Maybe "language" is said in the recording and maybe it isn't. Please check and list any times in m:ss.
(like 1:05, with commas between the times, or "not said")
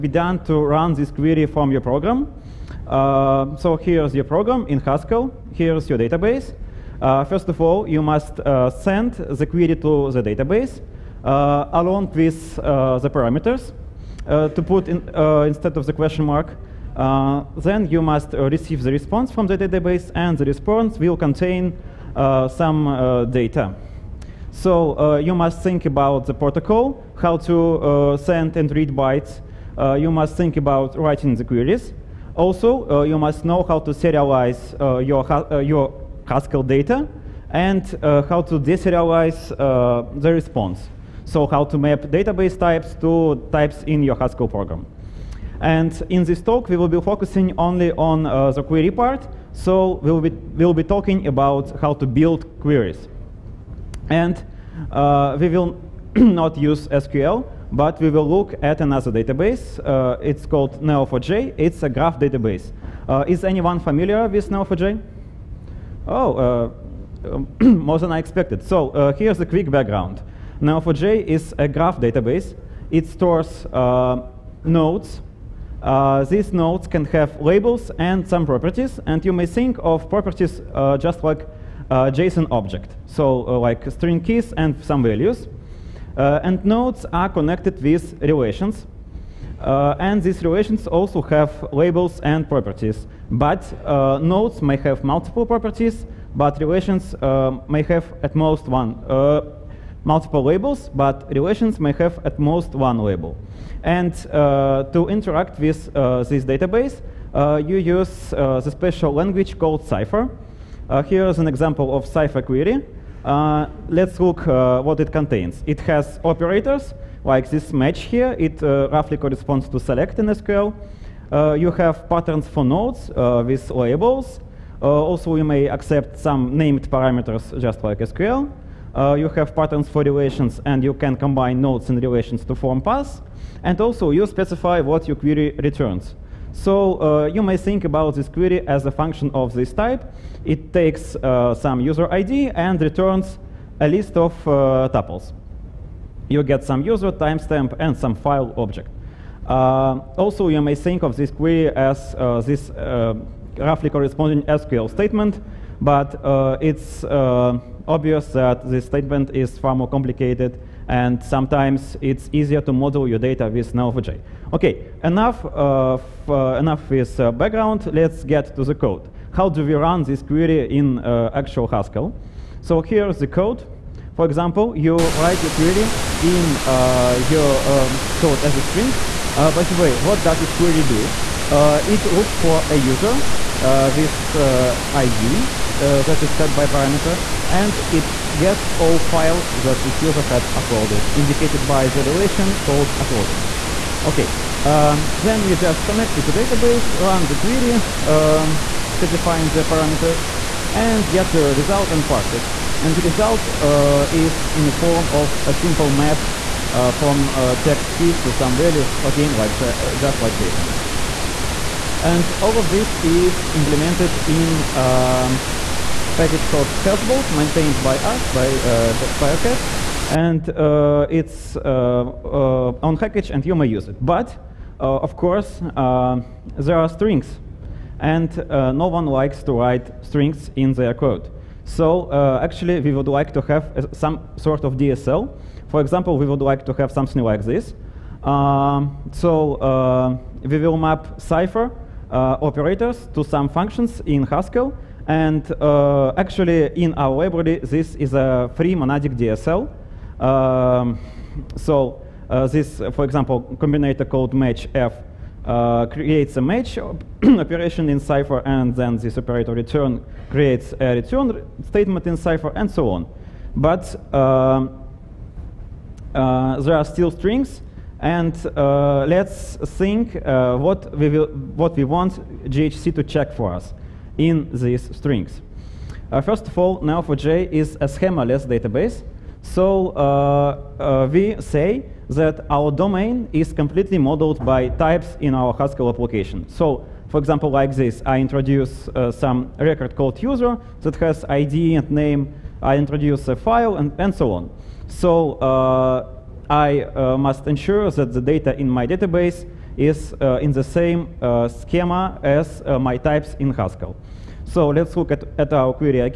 1:49.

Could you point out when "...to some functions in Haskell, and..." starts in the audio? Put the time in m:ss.
4:03.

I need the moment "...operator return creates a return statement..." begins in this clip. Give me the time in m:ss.
4:19.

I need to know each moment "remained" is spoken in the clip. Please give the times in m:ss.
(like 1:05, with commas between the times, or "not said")
not said.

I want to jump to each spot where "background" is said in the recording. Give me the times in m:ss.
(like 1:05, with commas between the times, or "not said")
1:09, 2:47.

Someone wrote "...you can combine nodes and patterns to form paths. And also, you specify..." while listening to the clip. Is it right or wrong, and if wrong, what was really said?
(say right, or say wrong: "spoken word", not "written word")
wrong: "relations", not "patterns".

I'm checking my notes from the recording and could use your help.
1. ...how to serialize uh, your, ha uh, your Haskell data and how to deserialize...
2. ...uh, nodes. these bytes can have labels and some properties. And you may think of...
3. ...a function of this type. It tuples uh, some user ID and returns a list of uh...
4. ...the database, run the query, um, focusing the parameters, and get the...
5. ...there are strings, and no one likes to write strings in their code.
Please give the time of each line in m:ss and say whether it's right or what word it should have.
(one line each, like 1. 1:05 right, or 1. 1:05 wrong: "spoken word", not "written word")
1. 0:33 right
2. 1:13 wrong: "nodes", not "bytes"
3. 2:18 wrong: "takes", not "tuples"
4. 3:16 wrong: "specifying", not "focusing"
5. 3:45 right.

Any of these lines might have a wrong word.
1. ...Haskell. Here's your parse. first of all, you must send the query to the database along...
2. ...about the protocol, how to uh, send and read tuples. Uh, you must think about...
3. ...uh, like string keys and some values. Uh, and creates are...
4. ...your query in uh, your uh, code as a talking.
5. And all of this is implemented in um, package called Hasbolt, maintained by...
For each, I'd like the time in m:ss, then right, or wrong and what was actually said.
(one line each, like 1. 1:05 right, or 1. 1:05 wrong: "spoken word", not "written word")
1. 0:04 wrong: "database", not "parse"
2. 0:25 wrong: "bytes", not "tuples"
3. 1:23 wrong: "nodes", not "creates"
4. 2:55 wrong: "string", not "talking"
5. 3:32 right.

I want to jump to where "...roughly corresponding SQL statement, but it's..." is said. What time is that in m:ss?
2:33.